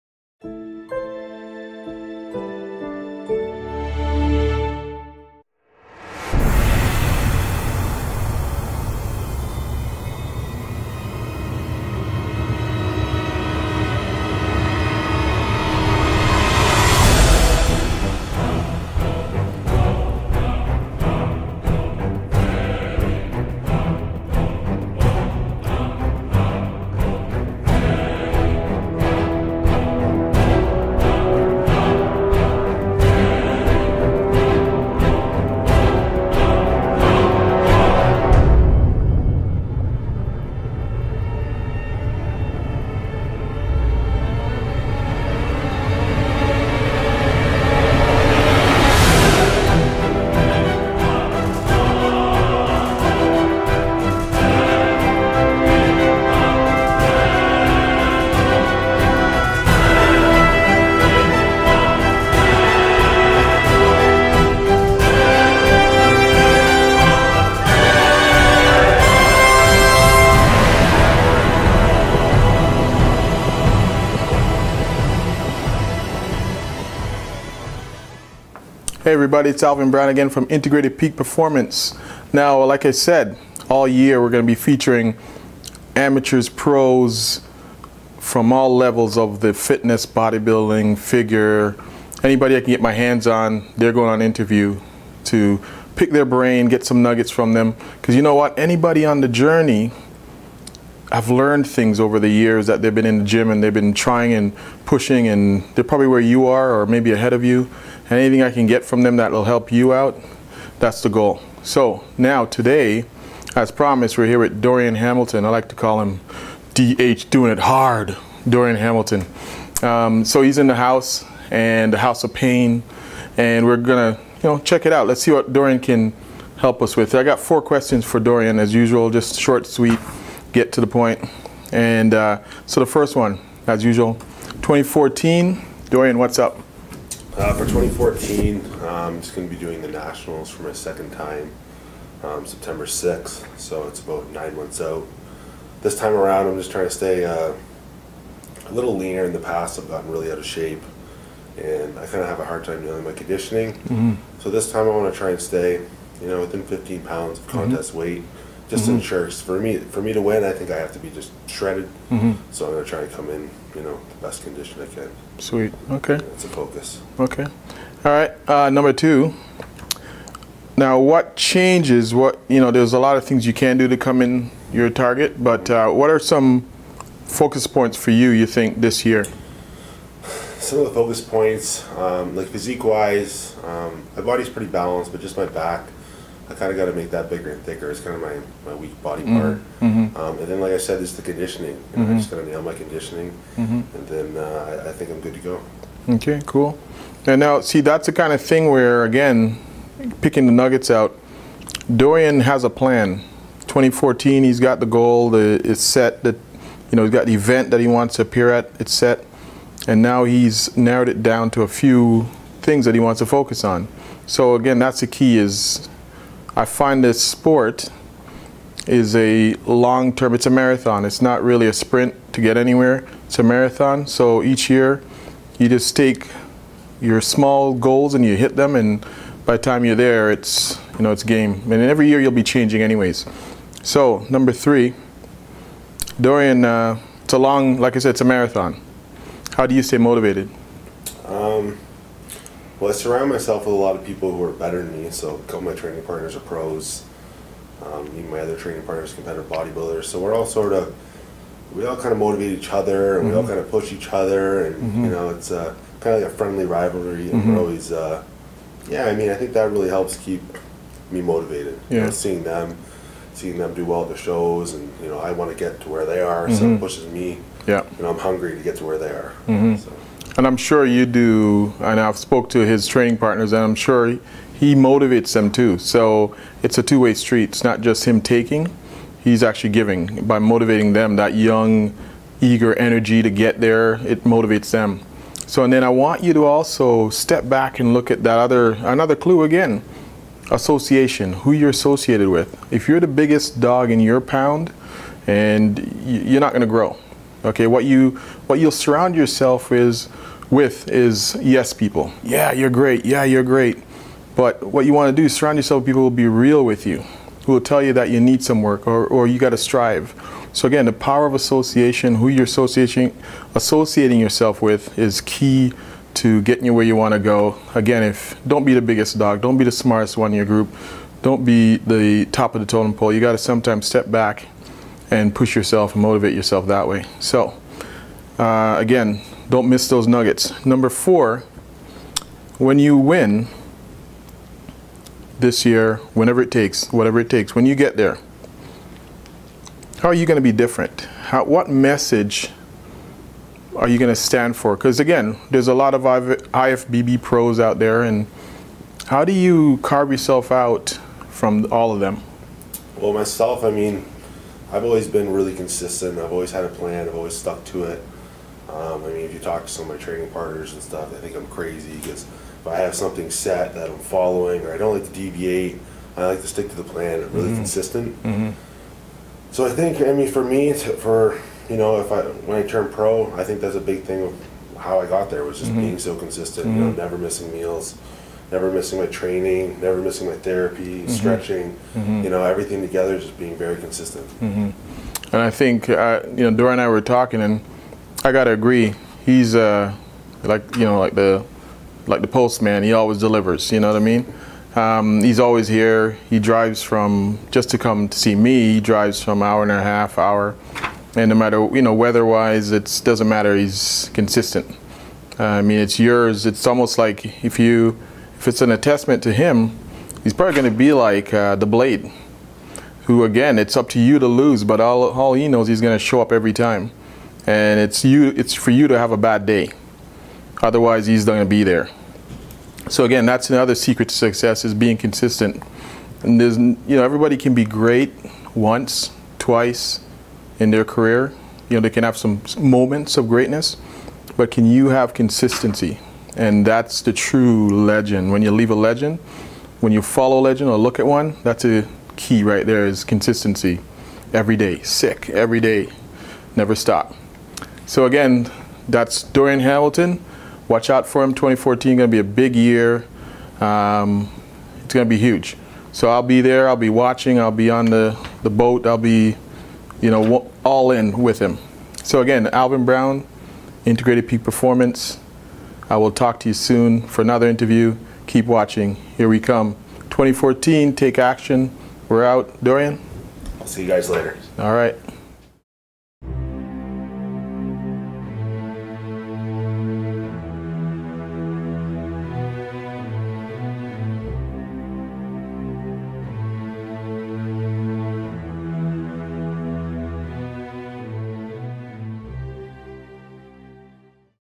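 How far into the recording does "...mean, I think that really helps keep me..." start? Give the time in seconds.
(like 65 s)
259 s.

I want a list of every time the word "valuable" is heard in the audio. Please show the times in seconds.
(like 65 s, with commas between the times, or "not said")
not said.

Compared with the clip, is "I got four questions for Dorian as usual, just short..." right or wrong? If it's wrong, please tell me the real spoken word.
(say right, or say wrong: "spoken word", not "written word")
right.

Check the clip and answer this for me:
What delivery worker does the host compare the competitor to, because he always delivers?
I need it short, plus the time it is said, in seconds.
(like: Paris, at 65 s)
Postman, at 392 s.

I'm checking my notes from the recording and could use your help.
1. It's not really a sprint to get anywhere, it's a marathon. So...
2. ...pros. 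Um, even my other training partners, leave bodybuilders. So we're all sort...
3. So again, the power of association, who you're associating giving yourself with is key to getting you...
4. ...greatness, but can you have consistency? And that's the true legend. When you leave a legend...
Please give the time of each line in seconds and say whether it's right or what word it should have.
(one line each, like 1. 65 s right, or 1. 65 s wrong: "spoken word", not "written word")
1. 221 s right
2. 246 s wrong: "competitive", not "leave"
3. 310 s wrong: "associating", not "giving"
4. 433 s right.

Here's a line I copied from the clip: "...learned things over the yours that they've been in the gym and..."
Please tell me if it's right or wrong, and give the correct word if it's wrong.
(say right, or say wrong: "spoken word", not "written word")
wrong: "years", not "yours".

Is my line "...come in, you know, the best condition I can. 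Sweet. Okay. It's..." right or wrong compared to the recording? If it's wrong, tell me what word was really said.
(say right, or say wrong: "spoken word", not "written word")
right.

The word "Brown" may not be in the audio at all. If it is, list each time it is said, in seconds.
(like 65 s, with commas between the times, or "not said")
79 s, 462 s.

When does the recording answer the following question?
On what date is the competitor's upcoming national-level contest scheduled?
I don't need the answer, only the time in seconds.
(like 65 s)
142 s.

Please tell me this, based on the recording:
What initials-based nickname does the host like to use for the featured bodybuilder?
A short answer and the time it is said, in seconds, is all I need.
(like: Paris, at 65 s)
DH doing it hard, at 116 s.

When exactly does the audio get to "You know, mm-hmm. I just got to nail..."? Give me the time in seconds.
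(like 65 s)
191 s.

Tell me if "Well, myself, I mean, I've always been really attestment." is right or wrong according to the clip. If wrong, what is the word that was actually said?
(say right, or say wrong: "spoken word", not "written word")
wrong: "consistent", not "attestment".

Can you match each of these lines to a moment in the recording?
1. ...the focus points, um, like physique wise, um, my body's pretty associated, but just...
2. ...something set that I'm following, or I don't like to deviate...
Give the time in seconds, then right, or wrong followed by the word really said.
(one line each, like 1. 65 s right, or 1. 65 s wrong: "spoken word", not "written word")
1. 180 s wrong: "balanced", not "associated"
2. 362 s right.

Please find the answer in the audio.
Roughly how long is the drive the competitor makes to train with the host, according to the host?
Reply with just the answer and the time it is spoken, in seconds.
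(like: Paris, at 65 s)
Hour and a half, at 399 s.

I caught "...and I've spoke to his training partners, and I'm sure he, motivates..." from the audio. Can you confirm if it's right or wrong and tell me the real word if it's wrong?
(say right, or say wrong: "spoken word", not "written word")
right.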